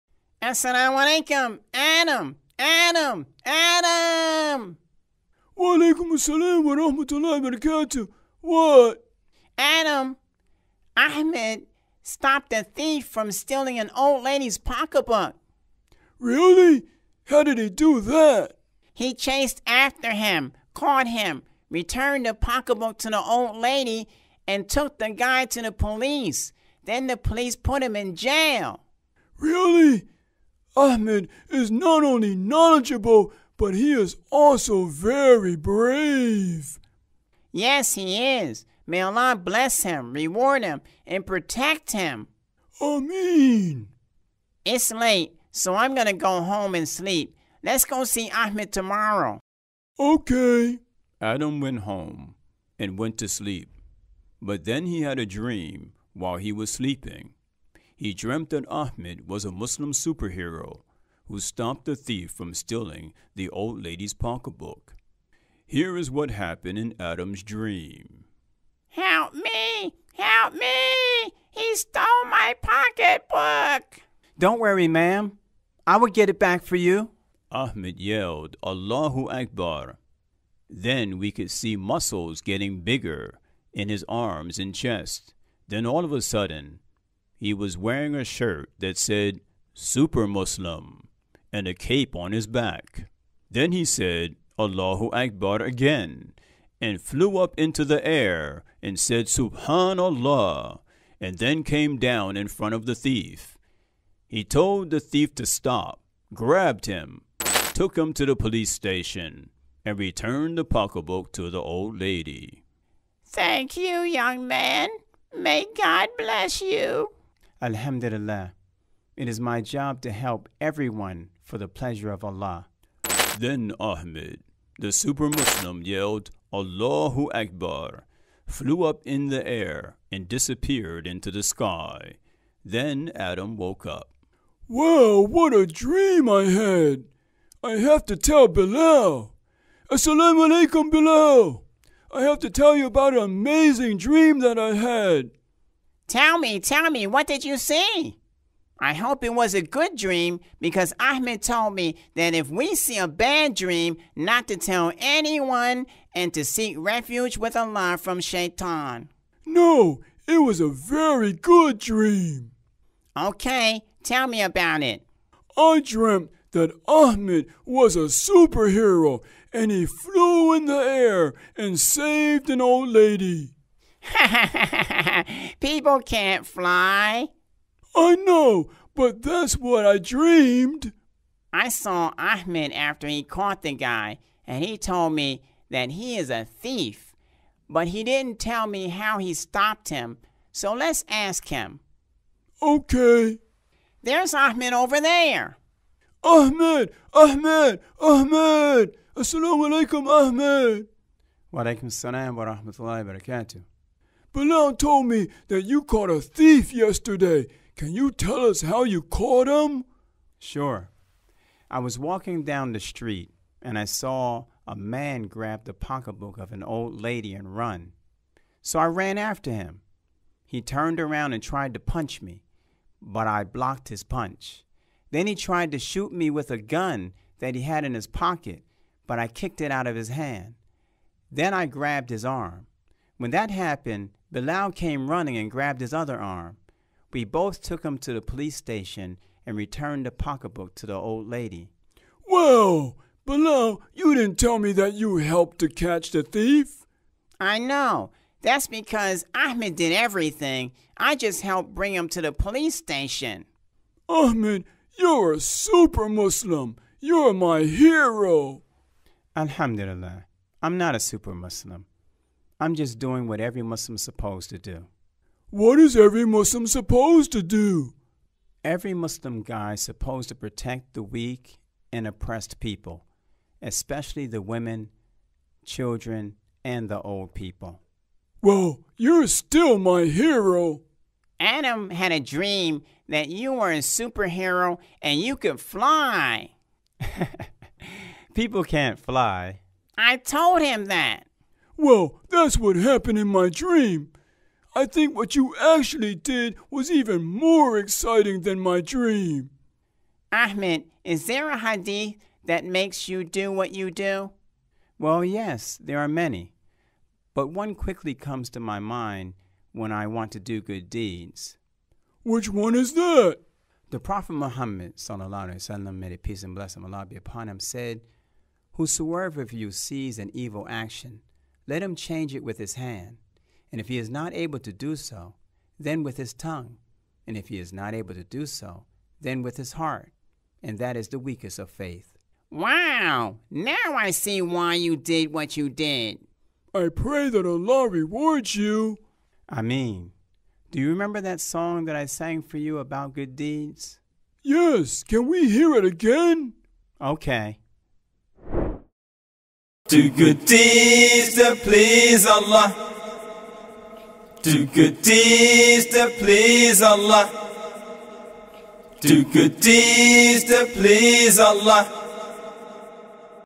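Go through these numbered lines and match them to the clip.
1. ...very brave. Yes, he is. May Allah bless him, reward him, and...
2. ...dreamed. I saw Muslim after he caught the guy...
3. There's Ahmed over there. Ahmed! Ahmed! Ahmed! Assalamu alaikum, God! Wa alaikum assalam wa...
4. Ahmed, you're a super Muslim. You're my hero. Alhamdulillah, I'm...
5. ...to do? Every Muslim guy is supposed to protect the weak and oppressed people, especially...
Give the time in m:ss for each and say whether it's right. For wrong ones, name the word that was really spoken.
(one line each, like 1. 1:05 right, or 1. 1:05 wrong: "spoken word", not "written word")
1. 0:34 right
2. 2:59 wrong: "Ahmed", not "Muslim"
3. 3:14 wrong: "Ahmed", not "God"
4. 4:14 right
5. 4:27 right.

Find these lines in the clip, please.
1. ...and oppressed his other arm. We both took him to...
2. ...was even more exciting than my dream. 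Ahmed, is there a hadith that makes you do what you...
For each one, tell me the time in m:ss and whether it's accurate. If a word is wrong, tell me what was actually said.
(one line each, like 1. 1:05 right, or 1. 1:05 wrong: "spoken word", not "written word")
1. 3:55 wrong: "grabbed", not "oppressed"
2. 4:56 right.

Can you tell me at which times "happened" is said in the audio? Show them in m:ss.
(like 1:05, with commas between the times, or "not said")
1:06, 3:53, 4:52.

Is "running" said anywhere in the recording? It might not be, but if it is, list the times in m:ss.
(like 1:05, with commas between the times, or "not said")
3:55.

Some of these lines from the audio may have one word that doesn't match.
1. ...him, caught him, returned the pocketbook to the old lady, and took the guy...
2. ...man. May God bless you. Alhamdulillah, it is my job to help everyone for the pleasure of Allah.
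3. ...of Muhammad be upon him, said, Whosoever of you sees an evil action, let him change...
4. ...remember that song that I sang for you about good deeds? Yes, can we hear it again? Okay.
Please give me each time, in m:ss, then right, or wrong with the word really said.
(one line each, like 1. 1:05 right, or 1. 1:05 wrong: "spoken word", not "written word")
1. 0:20 right
2. 1:54 right
3. 5:16 wrong: "Allah", not "Muhammad"
4. 5:40 right.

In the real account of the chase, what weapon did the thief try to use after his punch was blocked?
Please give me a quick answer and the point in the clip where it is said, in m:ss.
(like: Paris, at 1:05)
a gun, at 3:46.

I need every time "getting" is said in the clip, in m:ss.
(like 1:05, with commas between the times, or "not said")
1:22.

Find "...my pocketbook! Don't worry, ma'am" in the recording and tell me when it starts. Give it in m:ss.
1:12.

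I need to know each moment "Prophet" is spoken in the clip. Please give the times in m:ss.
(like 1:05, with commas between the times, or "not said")
5:13.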